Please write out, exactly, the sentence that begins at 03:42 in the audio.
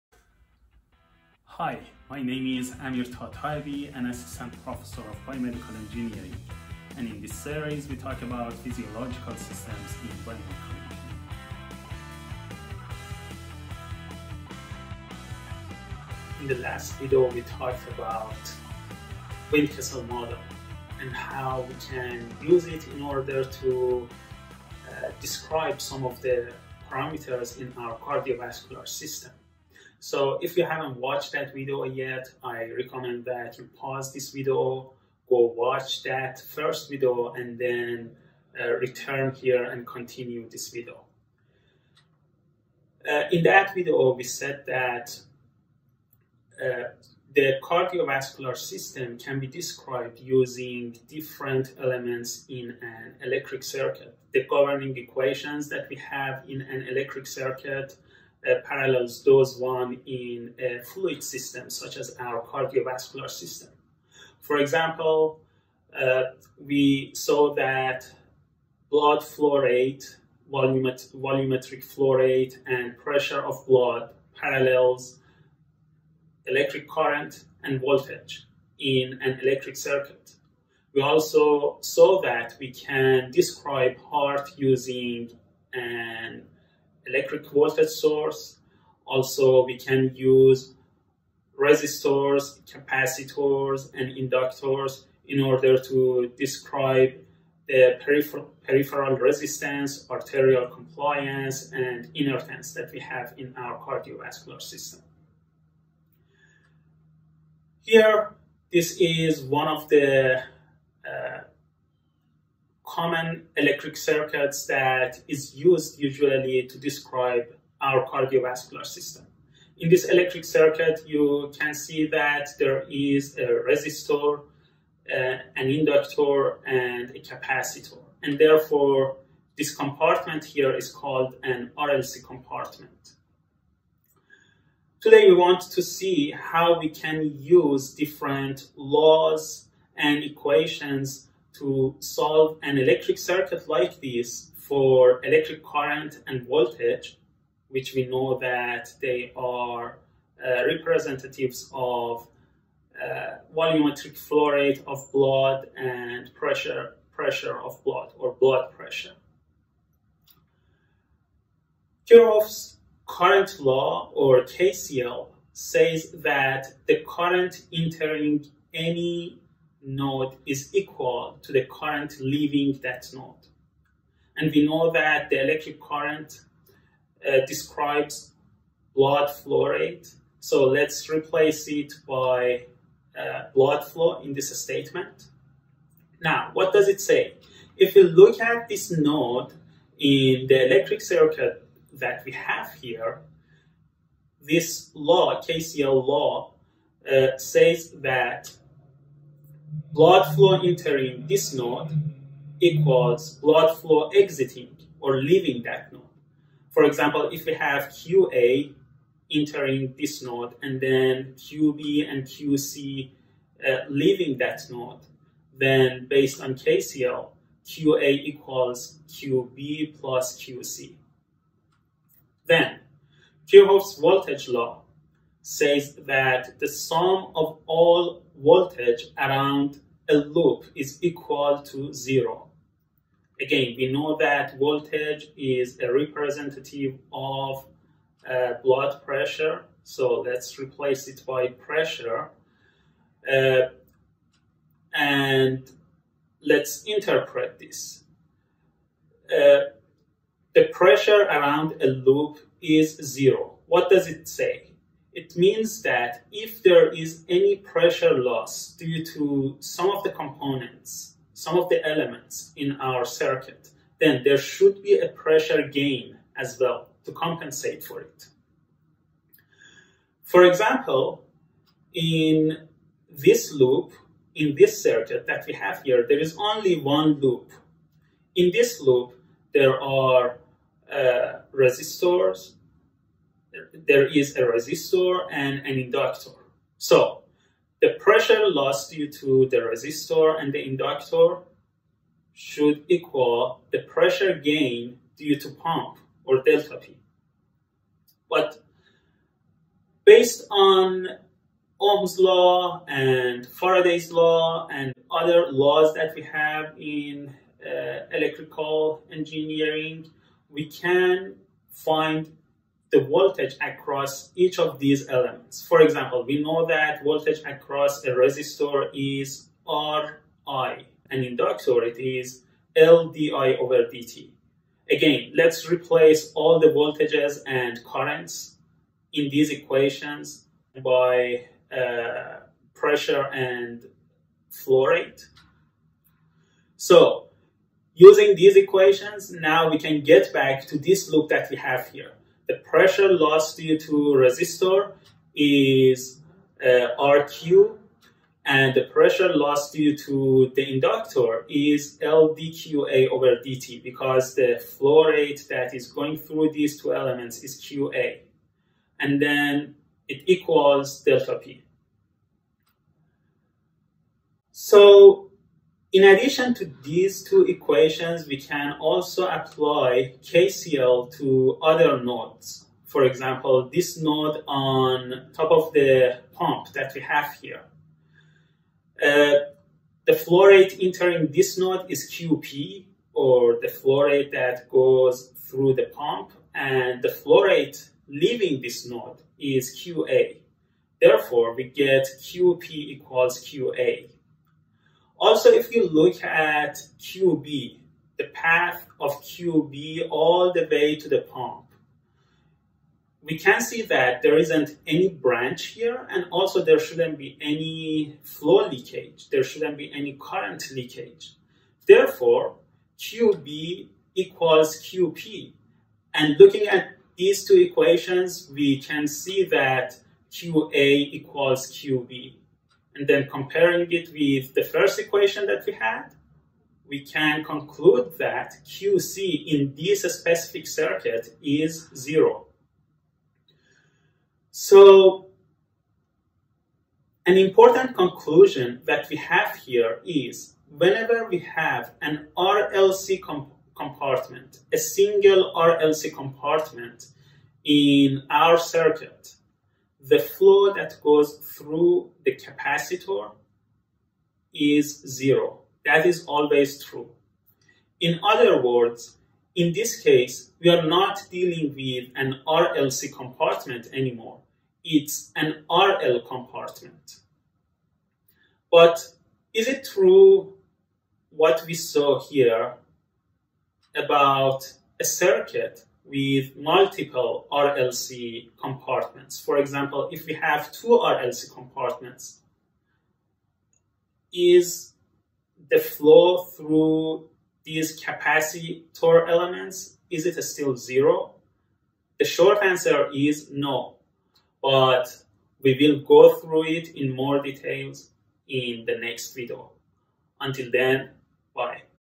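Then, Kirchhoff's voltage law says that the sum of all voltage around a loop is equal to zero.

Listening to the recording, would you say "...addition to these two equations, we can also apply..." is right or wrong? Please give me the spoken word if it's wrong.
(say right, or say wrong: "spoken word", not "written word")
right.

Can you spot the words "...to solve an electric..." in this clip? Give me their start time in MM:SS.
02:21.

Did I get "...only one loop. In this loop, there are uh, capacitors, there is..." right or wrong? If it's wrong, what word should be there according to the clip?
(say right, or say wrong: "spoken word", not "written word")
wrong: "resistors", not "capacitors".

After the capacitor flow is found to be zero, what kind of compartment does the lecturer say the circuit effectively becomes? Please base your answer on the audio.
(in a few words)
RL compartment.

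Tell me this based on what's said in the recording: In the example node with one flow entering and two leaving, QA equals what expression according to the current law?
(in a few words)
QB plus QC.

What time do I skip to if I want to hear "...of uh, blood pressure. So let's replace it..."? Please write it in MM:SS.
03:57.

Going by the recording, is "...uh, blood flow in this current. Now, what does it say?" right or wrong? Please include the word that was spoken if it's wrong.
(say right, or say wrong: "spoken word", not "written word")
wrong: "statement", not "current".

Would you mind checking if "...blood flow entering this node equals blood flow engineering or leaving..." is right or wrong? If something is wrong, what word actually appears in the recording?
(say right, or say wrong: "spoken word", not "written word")
wrong: "exiting", not "engineering".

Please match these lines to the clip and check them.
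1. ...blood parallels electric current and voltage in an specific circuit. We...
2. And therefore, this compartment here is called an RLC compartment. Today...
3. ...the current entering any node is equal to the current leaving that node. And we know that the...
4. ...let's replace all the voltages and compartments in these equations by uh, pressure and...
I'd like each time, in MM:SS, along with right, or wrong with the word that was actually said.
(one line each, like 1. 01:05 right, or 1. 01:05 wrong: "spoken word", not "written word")
1. 01:13 wrong: "electric", not "specific"
2. 02:08 right
3. 02:46 right
4. 05:25 wrong: "currents", not "compartments".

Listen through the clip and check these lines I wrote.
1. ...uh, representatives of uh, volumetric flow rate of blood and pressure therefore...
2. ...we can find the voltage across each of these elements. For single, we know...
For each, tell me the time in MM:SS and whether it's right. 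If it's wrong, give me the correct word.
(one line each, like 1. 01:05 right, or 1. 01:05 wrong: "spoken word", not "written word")
1. 02:30 wrong: "pressure", not "therefore"
2. 05:10 wrong: "example", not "single".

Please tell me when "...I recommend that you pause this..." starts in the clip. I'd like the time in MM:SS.
00:32.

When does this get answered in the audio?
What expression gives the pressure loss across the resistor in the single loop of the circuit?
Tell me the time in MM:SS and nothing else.
05:46.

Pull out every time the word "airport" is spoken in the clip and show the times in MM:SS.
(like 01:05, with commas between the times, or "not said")
not said.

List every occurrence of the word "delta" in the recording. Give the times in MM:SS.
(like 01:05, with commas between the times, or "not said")
04:56, 06:01.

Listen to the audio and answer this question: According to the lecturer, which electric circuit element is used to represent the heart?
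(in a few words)
electric voltage source.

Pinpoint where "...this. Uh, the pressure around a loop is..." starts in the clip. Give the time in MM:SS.
04:07.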